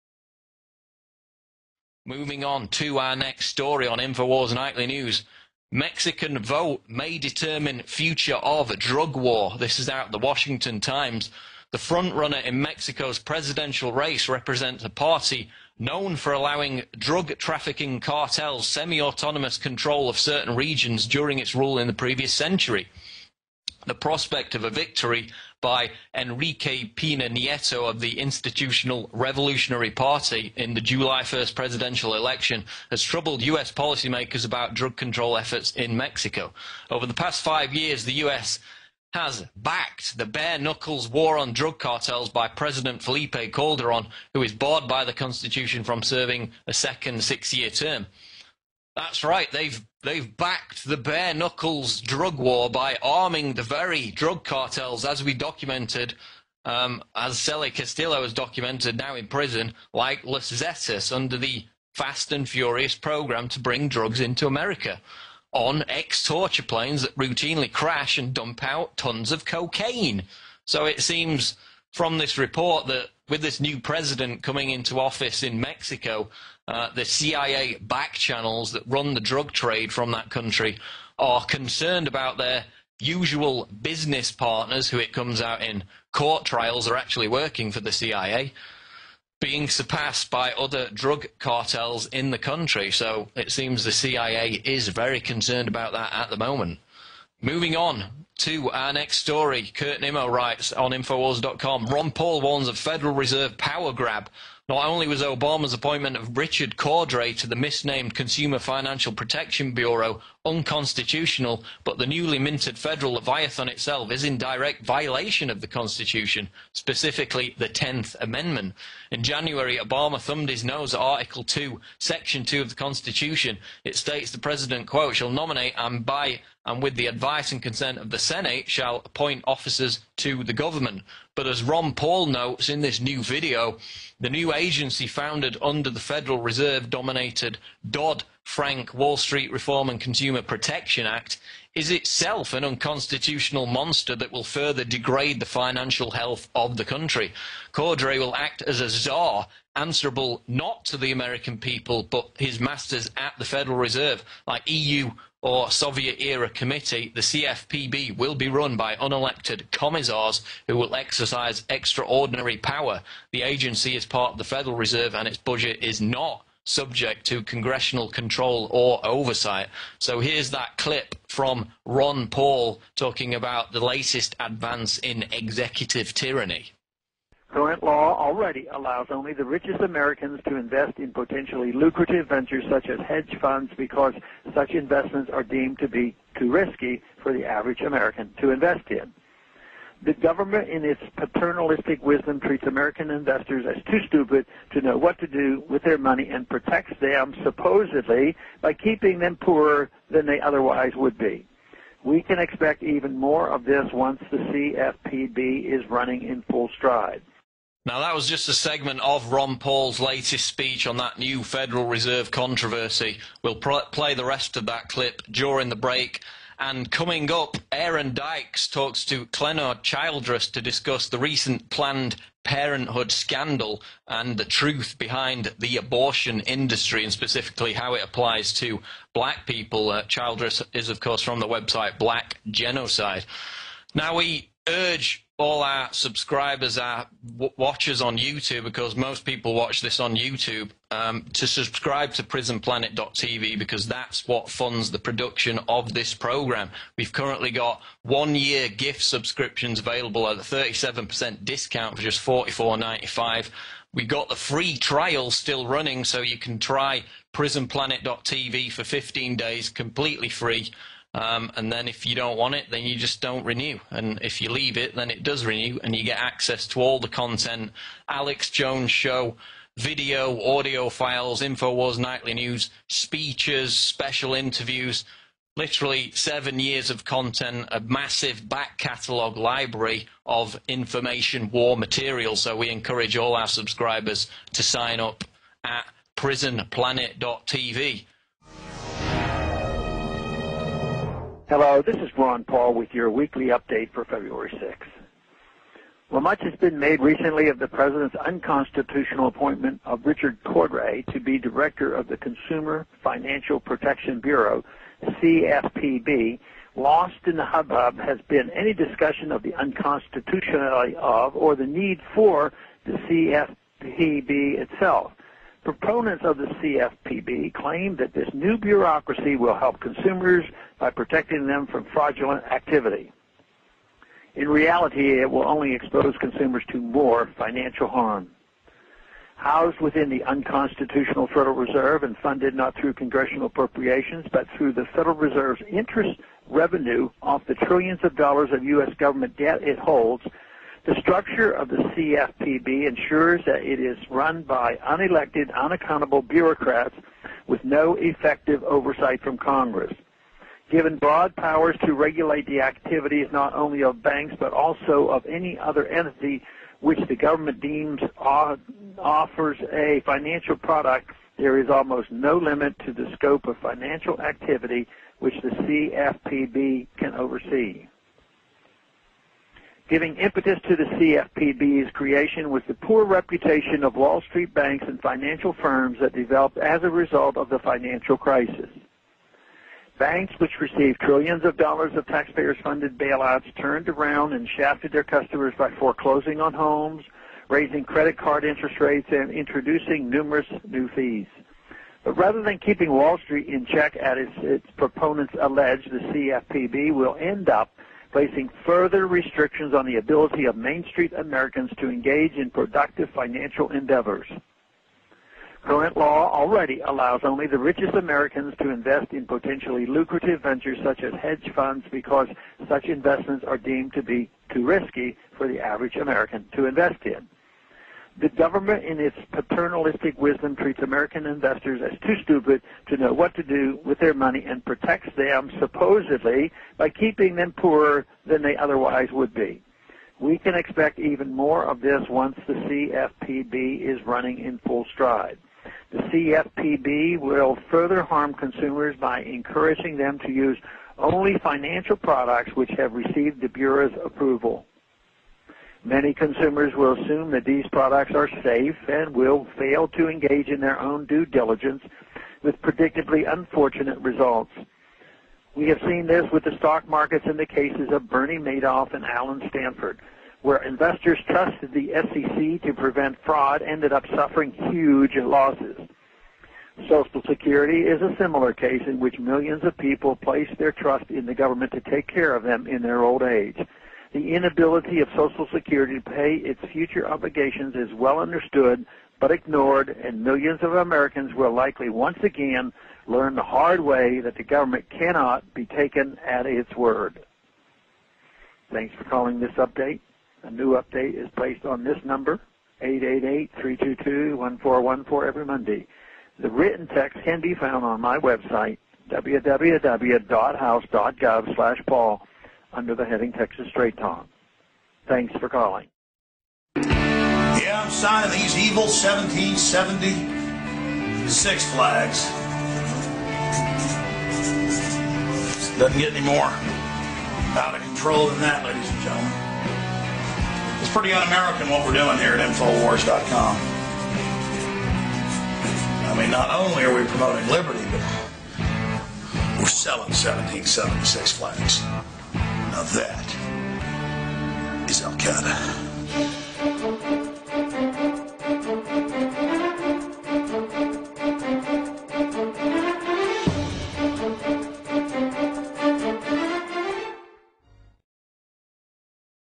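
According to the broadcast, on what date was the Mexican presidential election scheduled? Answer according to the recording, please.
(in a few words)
July 1st.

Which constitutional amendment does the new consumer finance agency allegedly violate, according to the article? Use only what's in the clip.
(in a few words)
10th Amendment.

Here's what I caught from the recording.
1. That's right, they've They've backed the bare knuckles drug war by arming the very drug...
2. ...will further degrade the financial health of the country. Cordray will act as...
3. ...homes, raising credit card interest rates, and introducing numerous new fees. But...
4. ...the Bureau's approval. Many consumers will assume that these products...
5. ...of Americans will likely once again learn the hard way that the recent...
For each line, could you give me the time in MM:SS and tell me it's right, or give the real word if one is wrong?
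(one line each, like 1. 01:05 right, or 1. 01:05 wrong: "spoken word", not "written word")
1. 00:48 right
2. 02:24 right
3. 06:26 right
4. 07:23 right
5. 08:00 wrong: "government", not "recent".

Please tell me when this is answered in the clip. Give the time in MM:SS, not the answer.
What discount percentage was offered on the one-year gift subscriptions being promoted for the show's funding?
04:10.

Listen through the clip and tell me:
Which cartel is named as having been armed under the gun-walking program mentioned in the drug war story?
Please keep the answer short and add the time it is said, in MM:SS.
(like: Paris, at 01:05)
Los Zetas, at 01:00.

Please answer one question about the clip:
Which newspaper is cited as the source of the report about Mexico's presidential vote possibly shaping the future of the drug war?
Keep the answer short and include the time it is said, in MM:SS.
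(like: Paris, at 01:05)
Washington Times, at 00:10.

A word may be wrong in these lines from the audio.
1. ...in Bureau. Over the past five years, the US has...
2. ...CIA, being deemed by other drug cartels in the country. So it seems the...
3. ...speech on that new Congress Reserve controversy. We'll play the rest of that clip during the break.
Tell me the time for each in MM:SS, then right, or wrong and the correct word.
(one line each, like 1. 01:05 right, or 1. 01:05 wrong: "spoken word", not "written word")
1. 00:35 wrong: "Mexico", not "Bureau"
2. 01:27 wrong: "surpassed", not "deemed"
3. 03:30 wrong: "Federal", not "Congress".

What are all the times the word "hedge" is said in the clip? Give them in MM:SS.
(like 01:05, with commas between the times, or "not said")
03:03, 06:51.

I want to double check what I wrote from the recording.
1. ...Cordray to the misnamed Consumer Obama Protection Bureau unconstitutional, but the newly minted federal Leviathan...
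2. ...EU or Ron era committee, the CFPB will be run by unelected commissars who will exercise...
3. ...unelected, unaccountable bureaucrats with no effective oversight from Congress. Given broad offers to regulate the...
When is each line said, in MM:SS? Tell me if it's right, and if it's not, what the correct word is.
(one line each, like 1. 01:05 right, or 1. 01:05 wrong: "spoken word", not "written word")
1. 01:46 wrong: "Financial", not "Obama"
2. 02:34 wrong: "Soviet", not "Ron"
3. 05:44 wrong: "powers", not "offers".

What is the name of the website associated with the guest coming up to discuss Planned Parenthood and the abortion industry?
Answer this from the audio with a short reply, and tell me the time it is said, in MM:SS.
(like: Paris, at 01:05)
Black Genocide, at 03:51.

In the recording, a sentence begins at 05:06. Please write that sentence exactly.
Lost in the hubbub has been any discussion of the unconstitutionality of or the need for the CFPB itself.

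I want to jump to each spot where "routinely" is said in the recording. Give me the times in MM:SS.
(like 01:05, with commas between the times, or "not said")
01:07.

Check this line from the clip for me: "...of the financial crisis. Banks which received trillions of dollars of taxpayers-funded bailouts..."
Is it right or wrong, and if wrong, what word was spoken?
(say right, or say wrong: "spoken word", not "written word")
right.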